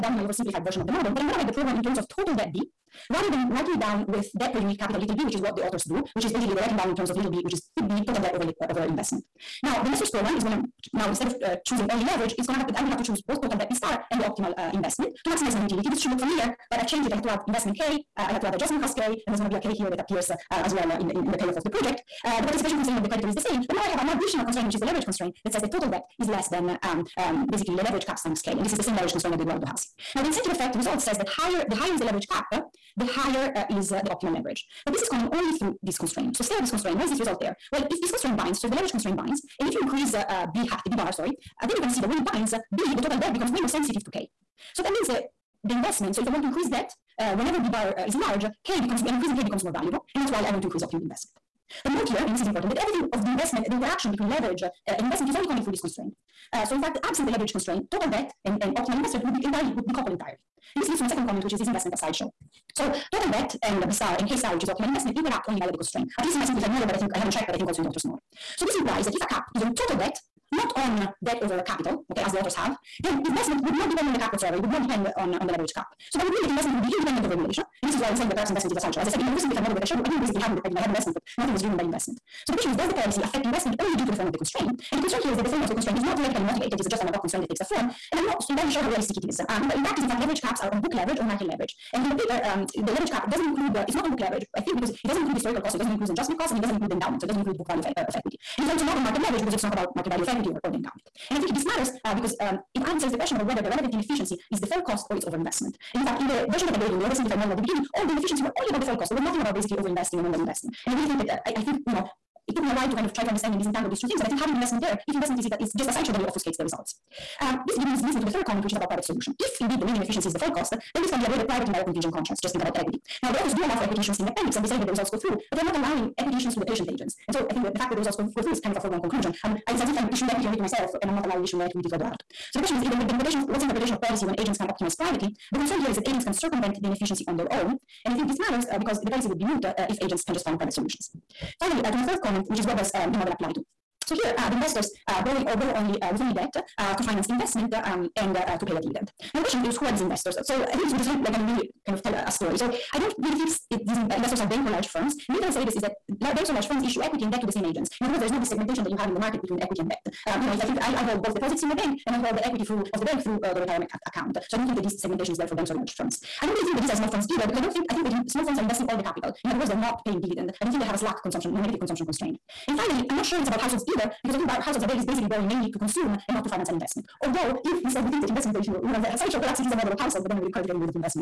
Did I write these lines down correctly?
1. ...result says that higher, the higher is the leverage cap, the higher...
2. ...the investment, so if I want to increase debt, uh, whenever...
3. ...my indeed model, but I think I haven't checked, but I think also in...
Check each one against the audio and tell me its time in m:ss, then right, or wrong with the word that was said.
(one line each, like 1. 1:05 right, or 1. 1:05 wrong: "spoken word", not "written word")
1. 0:30 right
2. 0:45 right
3. 1:06 wrong: "simplified", not "indeed".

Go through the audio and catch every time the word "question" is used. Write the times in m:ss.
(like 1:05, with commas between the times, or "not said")
1:22, 1:43, 2:12, 2:29.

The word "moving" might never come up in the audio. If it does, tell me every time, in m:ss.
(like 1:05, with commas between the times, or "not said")
not said.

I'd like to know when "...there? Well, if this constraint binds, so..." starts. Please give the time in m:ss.
0:37.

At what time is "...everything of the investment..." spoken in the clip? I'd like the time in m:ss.
0:52.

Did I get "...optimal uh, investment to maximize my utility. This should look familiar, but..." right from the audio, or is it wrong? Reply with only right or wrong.
right.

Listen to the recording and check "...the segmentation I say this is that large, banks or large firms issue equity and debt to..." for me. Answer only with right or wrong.
wrong.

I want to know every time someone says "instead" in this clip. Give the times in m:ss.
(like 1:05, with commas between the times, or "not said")
0:11, 2:57.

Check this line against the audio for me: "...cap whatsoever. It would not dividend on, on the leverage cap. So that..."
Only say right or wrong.
wrong.